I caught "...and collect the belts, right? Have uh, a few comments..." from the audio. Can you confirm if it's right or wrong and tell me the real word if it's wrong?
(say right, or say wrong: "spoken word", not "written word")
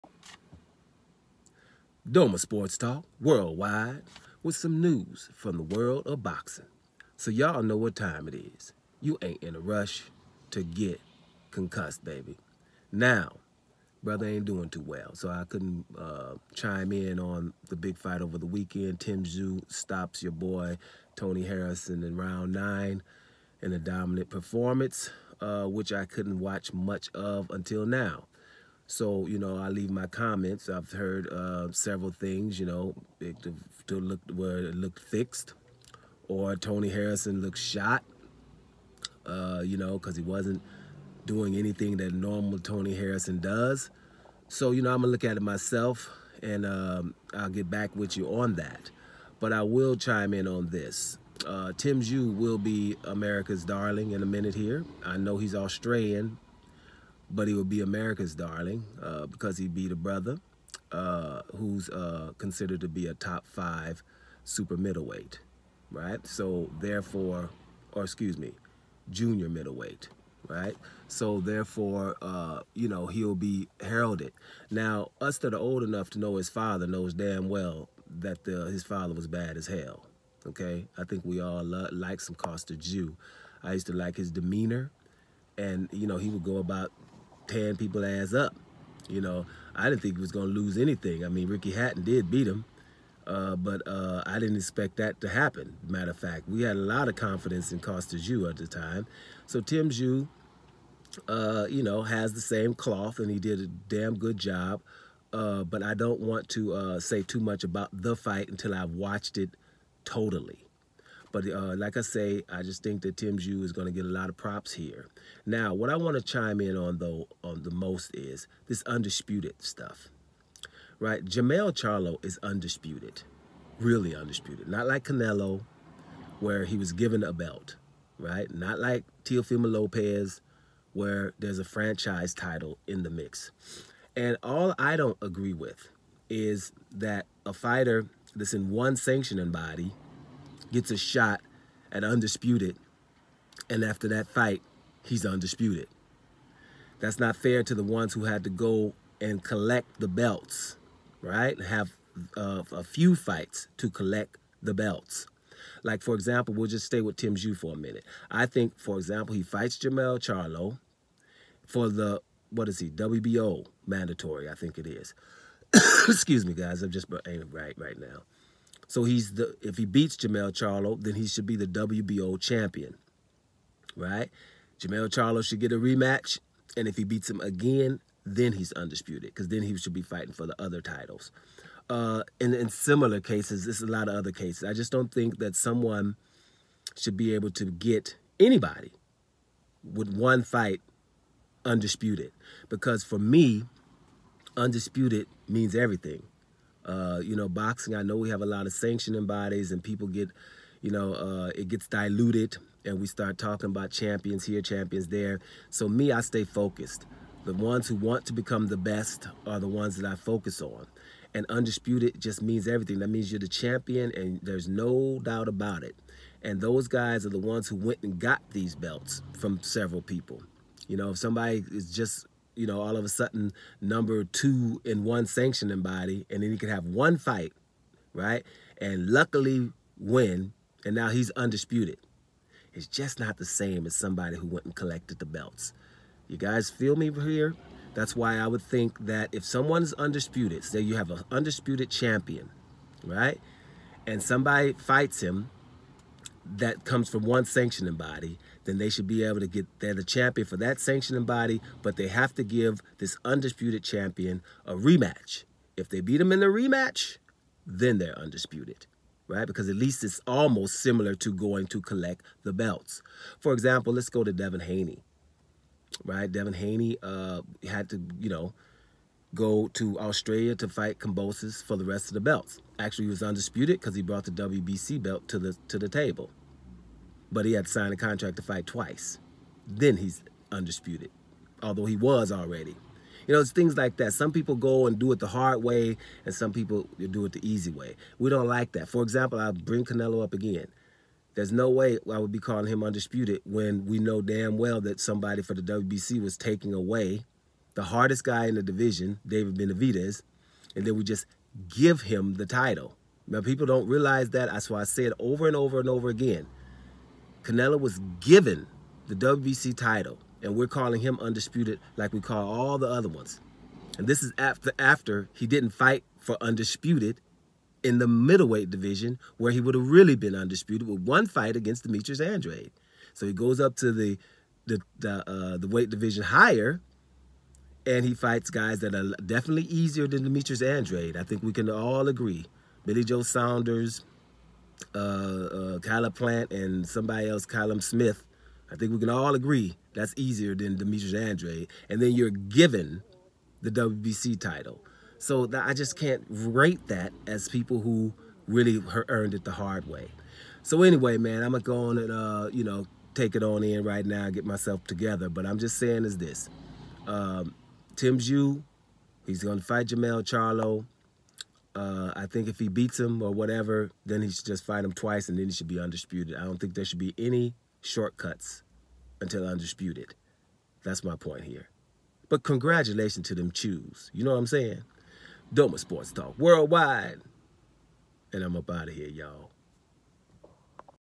wrong: "fights", not "comments".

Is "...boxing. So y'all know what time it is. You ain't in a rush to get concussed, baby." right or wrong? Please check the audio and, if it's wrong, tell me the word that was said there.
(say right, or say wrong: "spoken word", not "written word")
right.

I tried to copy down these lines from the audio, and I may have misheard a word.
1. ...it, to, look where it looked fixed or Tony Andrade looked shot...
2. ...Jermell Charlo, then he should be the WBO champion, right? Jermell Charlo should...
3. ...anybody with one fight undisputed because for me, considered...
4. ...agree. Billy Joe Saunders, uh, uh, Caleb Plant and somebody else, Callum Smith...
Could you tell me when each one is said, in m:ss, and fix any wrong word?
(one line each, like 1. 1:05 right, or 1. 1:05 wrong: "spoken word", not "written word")
1. 0:33 wrong: "Harrison", not "Andrade"
2. 2:50 right
3. 3:08 wrong: "undisputed", not "considered"
4. 5:32 right.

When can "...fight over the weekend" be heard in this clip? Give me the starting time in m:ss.
0:17.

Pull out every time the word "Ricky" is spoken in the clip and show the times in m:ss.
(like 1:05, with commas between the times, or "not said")
1:31.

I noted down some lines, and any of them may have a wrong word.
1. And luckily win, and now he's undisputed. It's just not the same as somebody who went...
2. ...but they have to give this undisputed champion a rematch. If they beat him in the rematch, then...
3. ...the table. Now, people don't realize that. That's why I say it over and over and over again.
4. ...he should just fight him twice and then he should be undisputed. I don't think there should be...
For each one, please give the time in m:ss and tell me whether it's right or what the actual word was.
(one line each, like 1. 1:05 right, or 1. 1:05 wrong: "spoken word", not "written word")
1. 3:48 right
2. 4:11 right
3. 5:02 wrong: "title", not "table"
4. 6:04 right.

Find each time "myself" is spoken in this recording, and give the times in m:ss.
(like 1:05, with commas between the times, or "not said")
0:45, 5:54.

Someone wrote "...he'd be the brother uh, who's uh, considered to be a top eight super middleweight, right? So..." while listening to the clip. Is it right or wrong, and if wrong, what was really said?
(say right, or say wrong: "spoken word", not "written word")
wrong: "five", not "eight".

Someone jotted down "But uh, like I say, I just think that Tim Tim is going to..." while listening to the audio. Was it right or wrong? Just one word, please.
wrong.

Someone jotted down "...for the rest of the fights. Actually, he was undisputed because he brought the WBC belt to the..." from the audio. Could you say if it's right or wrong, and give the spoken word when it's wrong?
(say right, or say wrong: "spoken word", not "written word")
wrong: "belts", not "fights".